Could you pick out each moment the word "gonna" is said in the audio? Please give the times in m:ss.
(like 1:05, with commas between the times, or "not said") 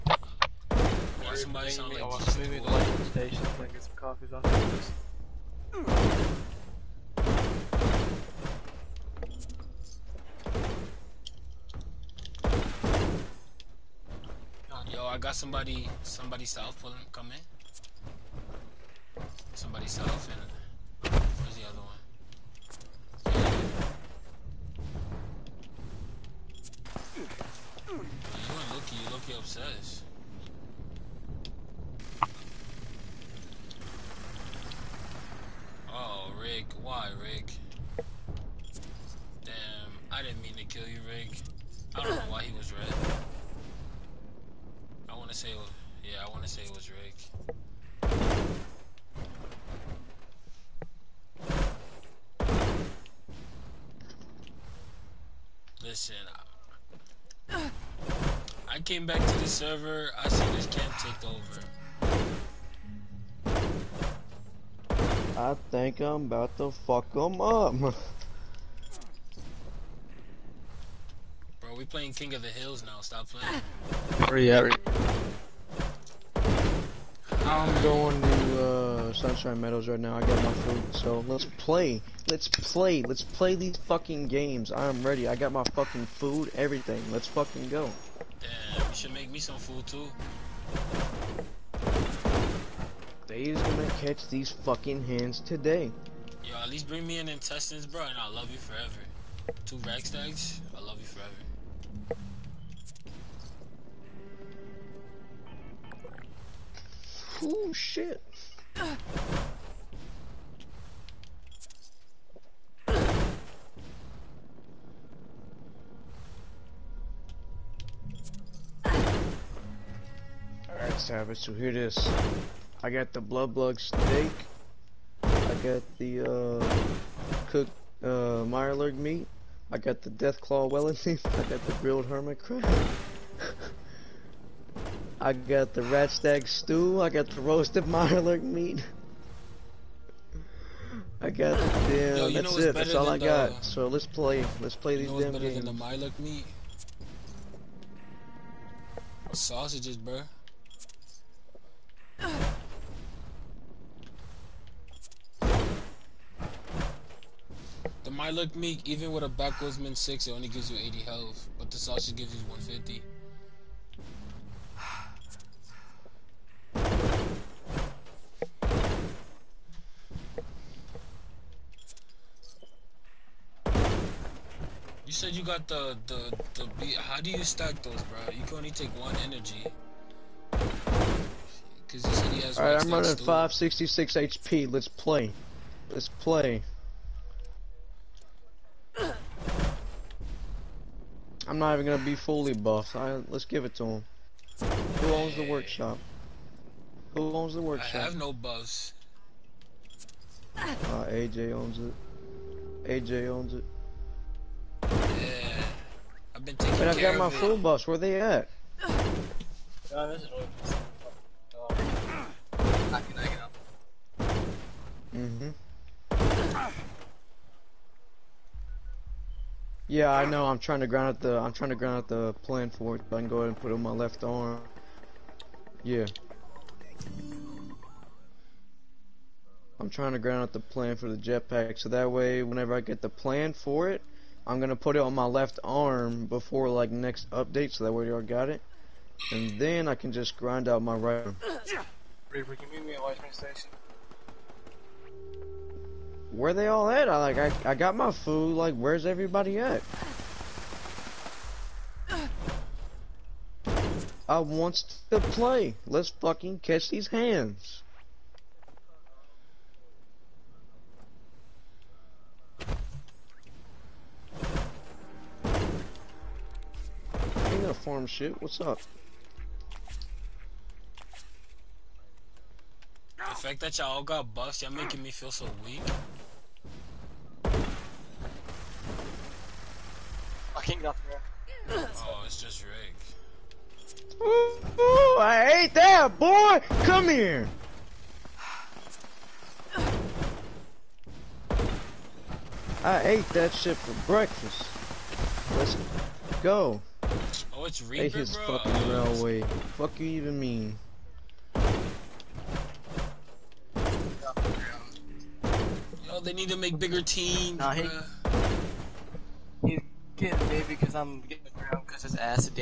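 1:33, 3:11, 3:54.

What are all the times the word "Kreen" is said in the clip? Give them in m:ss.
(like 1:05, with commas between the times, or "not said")
not said.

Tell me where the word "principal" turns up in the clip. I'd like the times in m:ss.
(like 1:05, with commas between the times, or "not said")
not said.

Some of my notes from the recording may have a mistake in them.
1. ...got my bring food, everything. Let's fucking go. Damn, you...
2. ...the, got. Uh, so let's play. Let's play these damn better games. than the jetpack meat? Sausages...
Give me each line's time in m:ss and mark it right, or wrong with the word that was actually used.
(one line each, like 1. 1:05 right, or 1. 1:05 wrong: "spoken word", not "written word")
1. 1:25 wrong: "fucking", not "bring"
2. 2:23 wrong: "marlock", not "jetpack".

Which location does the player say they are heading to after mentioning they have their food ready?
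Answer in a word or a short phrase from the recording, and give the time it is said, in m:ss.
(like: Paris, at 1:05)
Sunshine Meadows, at 1:19.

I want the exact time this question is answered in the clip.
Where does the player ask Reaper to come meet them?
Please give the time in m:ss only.
4:03.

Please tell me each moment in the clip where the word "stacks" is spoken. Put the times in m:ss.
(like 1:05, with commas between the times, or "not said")
1:40, 2:57.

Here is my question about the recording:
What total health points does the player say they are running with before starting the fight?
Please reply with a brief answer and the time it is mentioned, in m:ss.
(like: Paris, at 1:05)
566, at 3:03.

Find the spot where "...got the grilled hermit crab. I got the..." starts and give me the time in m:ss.
2:11.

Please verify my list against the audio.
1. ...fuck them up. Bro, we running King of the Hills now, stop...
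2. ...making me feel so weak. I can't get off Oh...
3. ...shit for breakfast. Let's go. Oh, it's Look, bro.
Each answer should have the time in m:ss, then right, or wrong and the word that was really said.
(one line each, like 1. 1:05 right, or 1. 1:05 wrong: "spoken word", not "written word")
1. 1:06 wrong: "playing", not "running"
2. 4:34 right
3. 4:53 wrong: "Reaper", not "Look".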